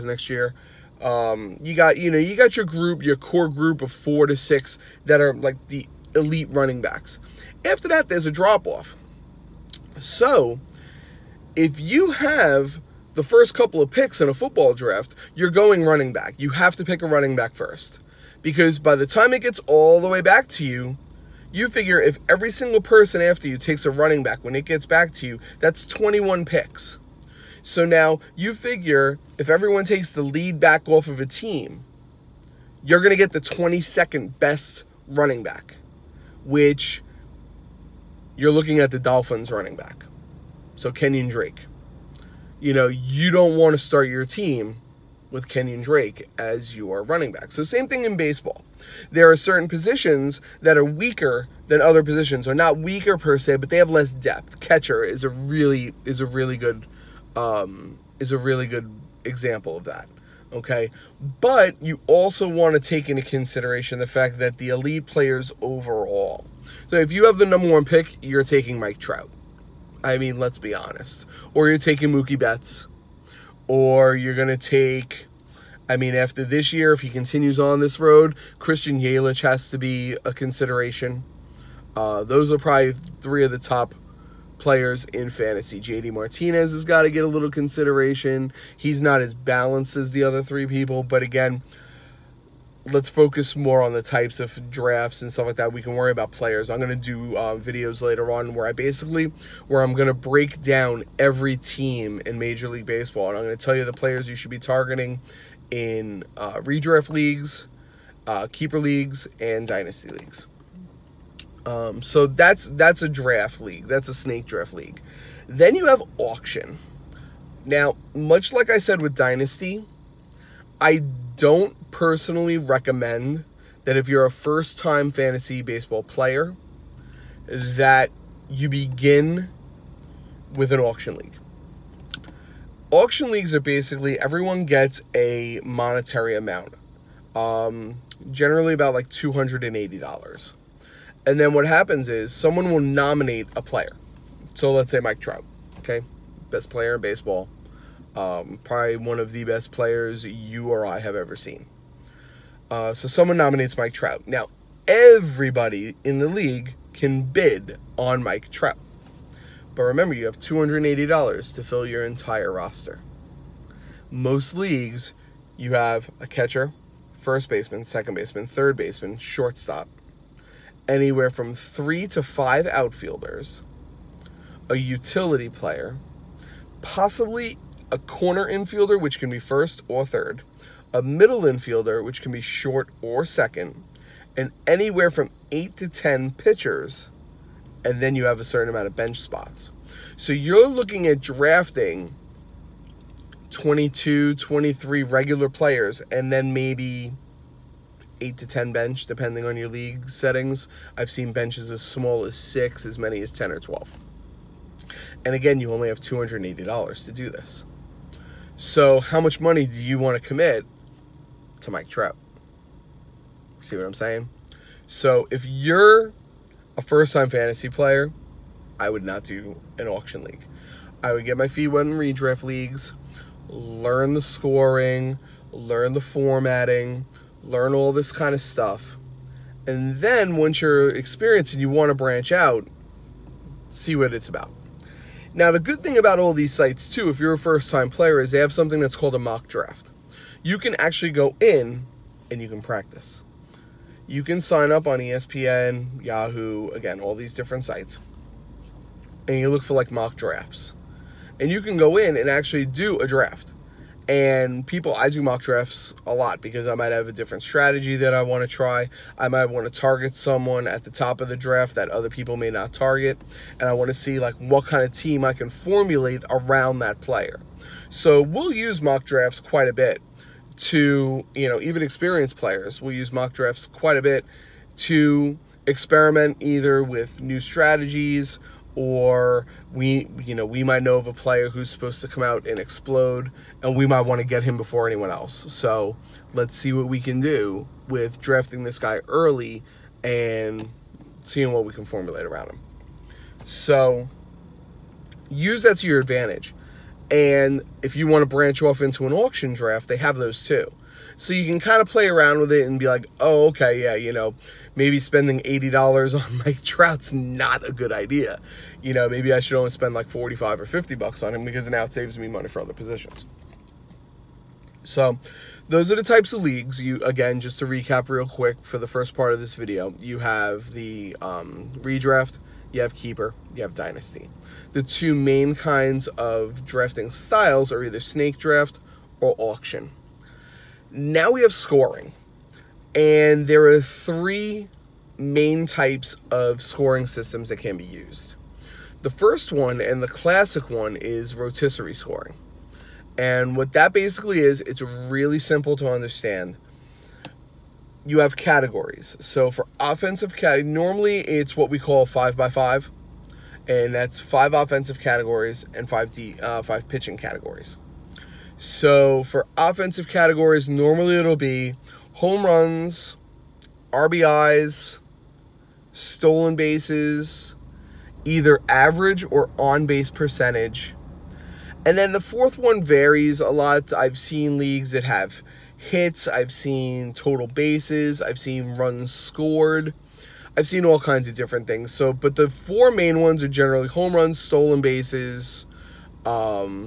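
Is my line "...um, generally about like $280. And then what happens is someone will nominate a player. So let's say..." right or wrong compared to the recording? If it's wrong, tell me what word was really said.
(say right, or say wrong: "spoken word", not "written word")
right.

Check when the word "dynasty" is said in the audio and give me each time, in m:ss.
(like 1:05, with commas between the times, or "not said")
1:49, 1:59, 5:23.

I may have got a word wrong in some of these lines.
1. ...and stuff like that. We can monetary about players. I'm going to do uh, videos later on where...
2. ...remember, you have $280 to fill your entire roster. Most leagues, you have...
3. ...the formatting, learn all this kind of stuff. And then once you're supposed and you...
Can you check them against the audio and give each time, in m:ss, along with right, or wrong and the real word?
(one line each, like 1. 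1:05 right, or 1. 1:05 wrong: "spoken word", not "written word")
1. 1:35 wrong: "worry", not "monetary"
2. 2:39 right
3. 3:45 wrong: "experienced", not "supposed".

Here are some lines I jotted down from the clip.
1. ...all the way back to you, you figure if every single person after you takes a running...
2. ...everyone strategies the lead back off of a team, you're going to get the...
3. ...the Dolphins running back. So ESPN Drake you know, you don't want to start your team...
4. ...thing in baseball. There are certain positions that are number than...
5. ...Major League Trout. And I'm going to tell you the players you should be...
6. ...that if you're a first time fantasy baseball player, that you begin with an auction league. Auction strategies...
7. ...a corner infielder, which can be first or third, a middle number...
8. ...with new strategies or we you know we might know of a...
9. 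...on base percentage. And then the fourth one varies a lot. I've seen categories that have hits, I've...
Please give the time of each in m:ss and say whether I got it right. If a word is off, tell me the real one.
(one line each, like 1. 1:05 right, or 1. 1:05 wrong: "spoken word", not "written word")
1. 0:19 right
2. 0:29 wrong: "takes", not "strategies"
3. 0:38 wrong: "Kenyon", not "ESPN"
4. 0:47 wrong: "weaker", not "number"
5. 1:42 wrong: "Baseball", not "Trout"
6. 2:03 wrong: "leagues", not "strategies"
7. 2:57 wrong: "infielder", not "number"
8. 4:36 right
9. 6:09 wrong: "leagues", not "categories".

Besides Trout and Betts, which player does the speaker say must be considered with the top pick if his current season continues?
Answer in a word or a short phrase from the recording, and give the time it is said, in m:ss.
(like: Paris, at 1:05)
Christian Yelich, at 1:18.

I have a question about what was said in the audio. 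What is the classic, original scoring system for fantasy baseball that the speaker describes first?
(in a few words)
Rotisserie scoring.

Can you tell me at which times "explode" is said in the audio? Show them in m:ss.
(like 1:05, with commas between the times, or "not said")
4:42.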